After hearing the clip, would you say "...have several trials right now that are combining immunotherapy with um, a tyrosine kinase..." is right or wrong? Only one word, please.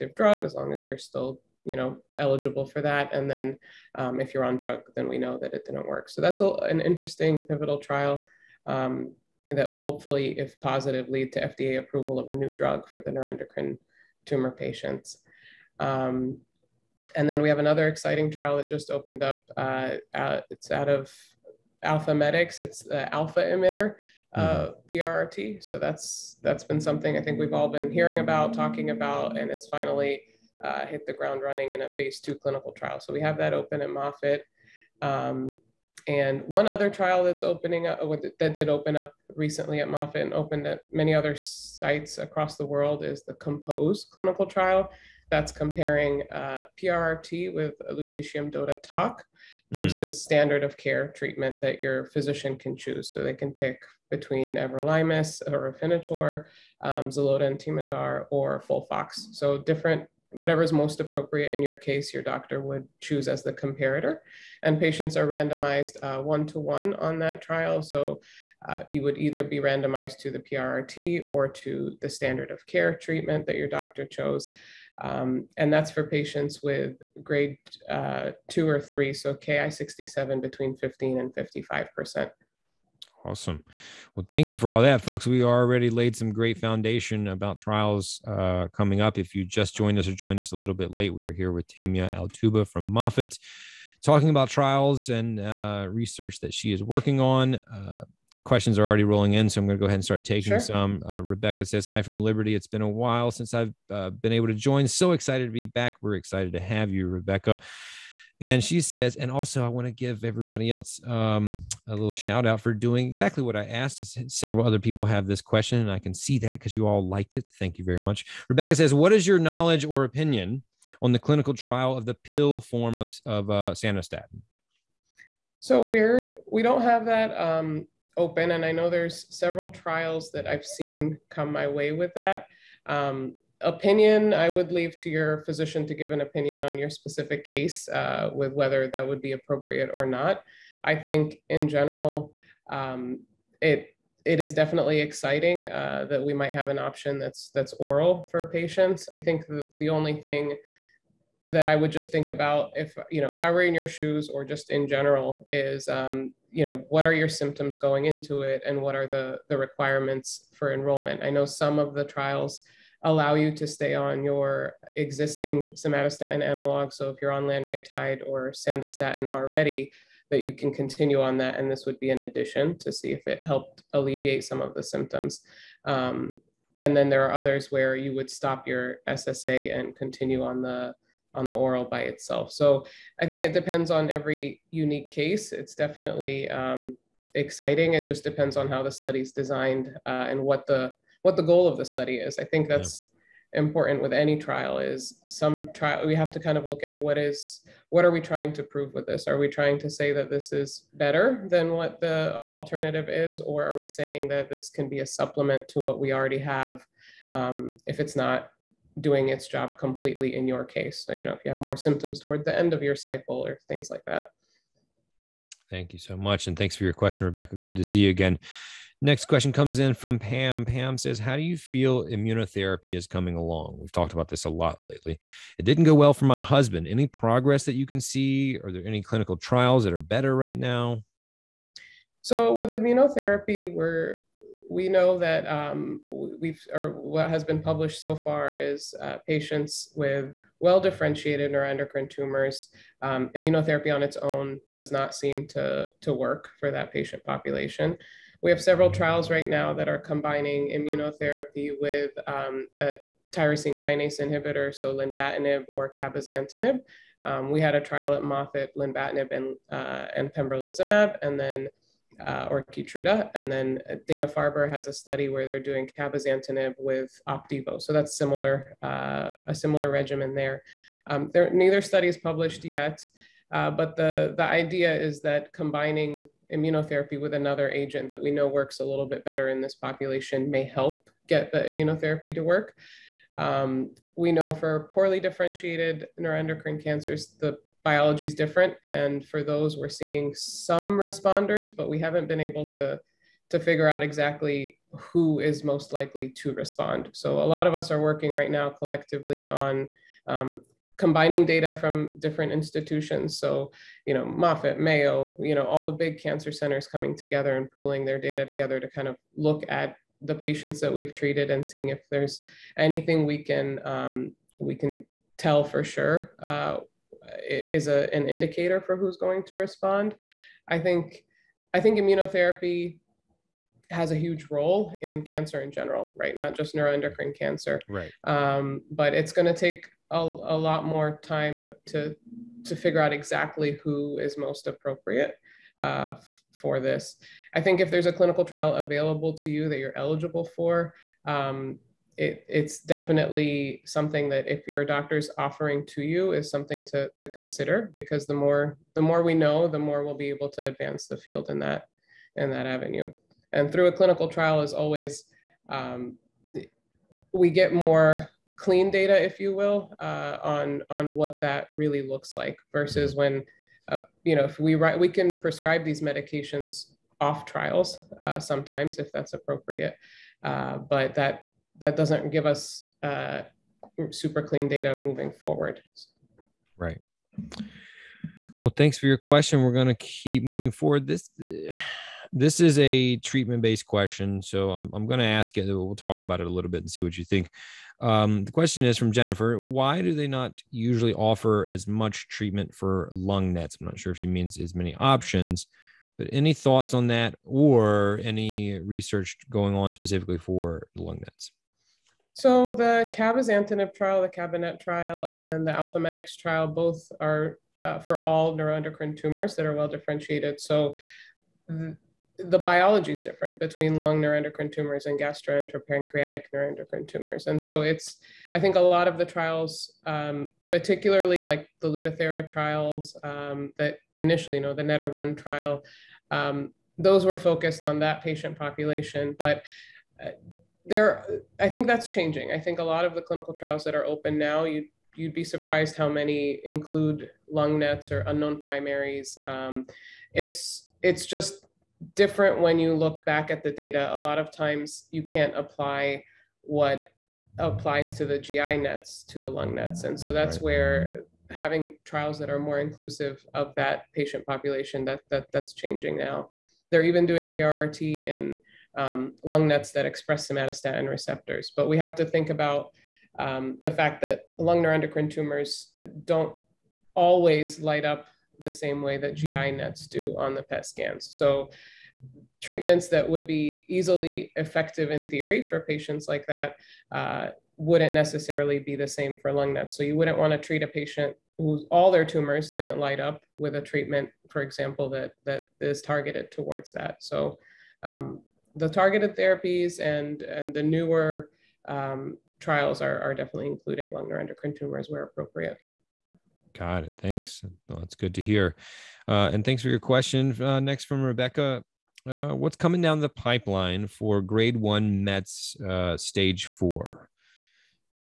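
right.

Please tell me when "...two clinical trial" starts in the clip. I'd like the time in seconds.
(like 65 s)
32 s.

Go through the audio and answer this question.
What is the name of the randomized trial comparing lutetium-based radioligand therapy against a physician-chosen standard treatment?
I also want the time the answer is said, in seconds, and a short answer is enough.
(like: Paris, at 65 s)
Compose, at 43 s.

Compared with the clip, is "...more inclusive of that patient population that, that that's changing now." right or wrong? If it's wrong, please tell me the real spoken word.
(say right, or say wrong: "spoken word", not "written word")
right.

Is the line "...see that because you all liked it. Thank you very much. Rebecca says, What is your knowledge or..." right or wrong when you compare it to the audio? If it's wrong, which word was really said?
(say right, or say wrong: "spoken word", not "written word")
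right.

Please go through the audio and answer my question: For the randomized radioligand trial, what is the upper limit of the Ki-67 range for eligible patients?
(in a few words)
55 percent.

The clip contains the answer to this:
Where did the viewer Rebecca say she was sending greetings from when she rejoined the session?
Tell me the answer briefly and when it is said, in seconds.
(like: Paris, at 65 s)
Liberty, at 102 s.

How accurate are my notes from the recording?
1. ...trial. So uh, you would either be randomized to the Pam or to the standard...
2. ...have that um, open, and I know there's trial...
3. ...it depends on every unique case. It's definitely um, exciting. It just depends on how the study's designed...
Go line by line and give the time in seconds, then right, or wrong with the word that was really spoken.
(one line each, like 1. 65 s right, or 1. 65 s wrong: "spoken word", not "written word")
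1. 67 s wrong: "PRRT", not "Pam"
2. 126 s wrong: "several", not "trial"
3. 183 s right.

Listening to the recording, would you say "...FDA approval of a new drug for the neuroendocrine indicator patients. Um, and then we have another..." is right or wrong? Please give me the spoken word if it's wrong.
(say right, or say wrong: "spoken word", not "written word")
wrong: "tumor", not "indicator".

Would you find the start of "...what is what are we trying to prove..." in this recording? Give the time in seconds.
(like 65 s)
196 s.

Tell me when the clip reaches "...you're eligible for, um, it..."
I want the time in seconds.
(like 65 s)
339 s.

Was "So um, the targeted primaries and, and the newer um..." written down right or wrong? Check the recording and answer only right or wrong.
wrong.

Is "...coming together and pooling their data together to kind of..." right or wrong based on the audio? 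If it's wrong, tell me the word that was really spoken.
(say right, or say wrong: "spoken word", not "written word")
right.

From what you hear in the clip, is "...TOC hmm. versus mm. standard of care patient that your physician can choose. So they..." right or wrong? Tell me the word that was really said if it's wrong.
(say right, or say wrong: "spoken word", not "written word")
wrong: "treatment", not "patient".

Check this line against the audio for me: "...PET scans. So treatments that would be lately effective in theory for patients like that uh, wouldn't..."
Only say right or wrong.
wrong.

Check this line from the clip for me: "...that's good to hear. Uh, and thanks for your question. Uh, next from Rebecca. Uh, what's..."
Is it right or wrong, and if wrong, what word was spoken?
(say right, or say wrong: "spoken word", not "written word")
right.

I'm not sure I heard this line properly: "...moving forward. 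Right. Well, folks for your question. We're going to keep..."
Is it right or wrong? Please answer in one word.
wrong.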